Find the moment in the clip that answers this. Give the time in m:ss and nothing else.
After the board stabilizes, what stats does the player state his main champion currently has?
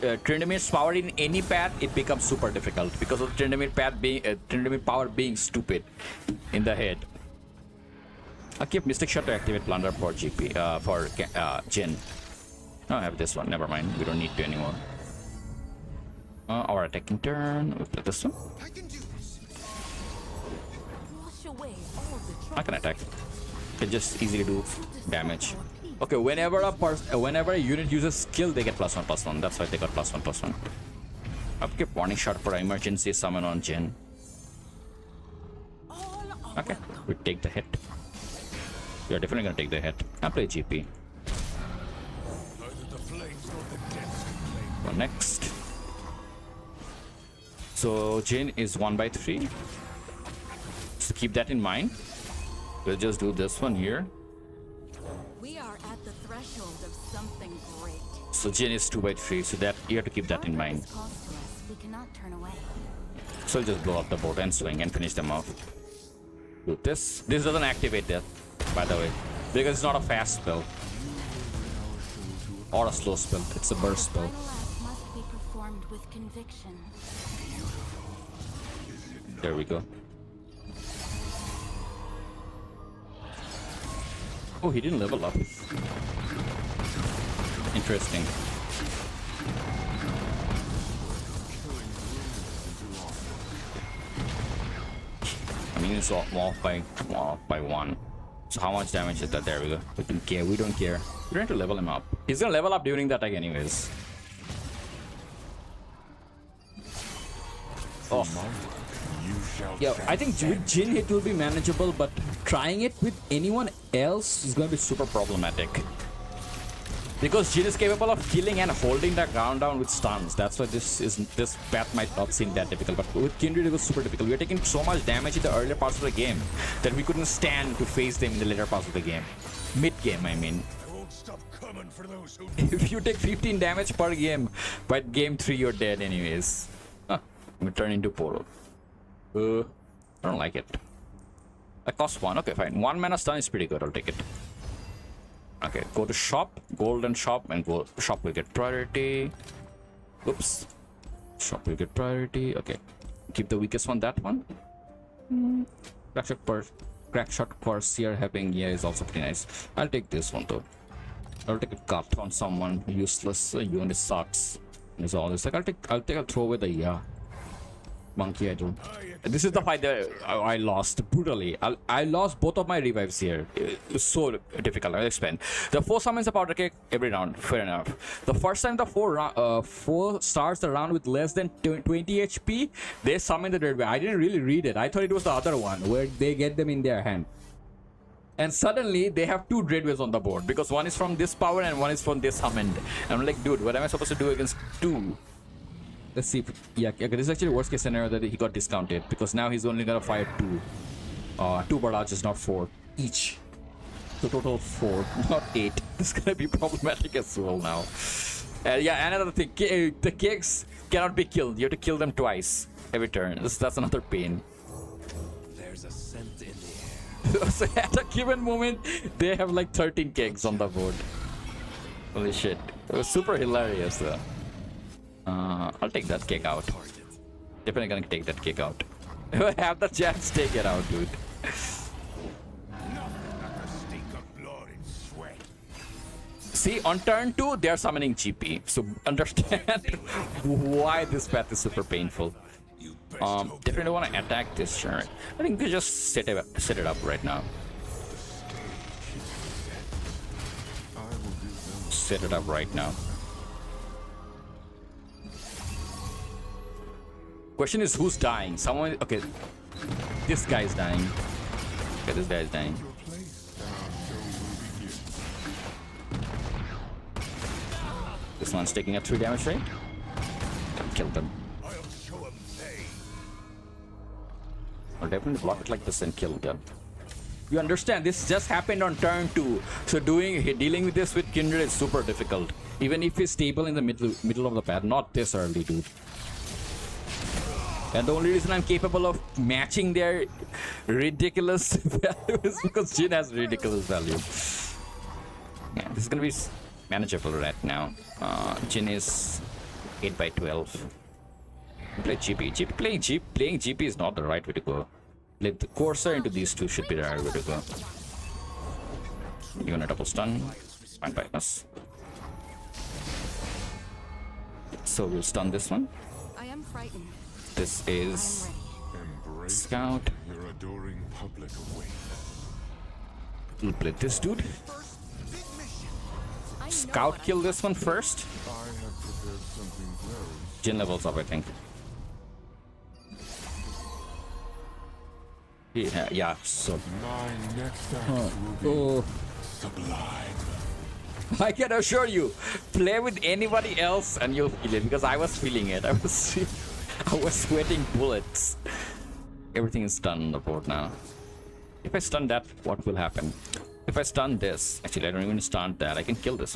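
5:00.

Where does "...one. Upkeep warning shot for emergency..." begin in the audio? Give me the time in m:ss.
0:30.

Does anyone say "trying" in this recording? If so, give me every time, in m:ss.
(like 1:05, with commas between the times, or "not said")
1:41, 1:52.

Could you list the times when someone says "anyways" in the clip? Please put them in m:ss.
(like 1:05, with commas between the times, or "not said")
1:43, 2:16.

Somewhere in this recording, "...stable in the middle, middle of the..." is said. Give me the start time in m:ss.
4:43.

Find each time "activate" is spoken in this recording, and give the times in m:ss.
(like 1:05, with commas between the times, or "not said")
0:09, 1:07.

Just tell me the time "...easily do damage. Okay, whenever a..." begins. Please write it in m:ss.
0:24.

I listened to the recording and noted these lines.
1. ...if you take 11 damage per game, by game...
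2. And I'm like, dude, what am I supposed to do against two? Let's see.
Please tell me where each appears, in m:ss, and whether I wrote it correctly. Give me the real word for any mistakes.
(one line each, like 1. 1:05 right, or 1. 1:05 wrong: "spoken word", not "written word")
1. 2:12 wrong: "15", not "11"
2. 3:13 right.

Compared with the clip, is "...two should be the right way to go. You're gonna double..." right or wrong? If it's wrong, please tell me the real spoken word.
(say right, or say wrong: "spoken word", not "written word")
right.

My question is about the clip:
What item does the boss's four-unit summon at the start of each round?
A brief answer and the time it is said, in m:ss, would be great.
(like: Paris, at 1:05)
Powder keg, at 2:56.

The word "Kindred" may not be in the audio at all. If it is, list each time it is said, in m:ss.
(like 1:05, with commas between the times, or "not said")
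2:03, 4:41.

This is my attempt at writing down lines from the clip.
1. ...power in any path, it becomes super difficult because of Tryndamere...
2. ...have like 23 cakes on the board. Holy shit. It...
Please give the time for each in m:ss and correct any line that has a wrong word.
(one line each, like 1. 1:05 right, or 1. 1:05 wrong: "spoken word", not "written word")
1. 0:00 right
2. 3:39 wrong: "13", not "23".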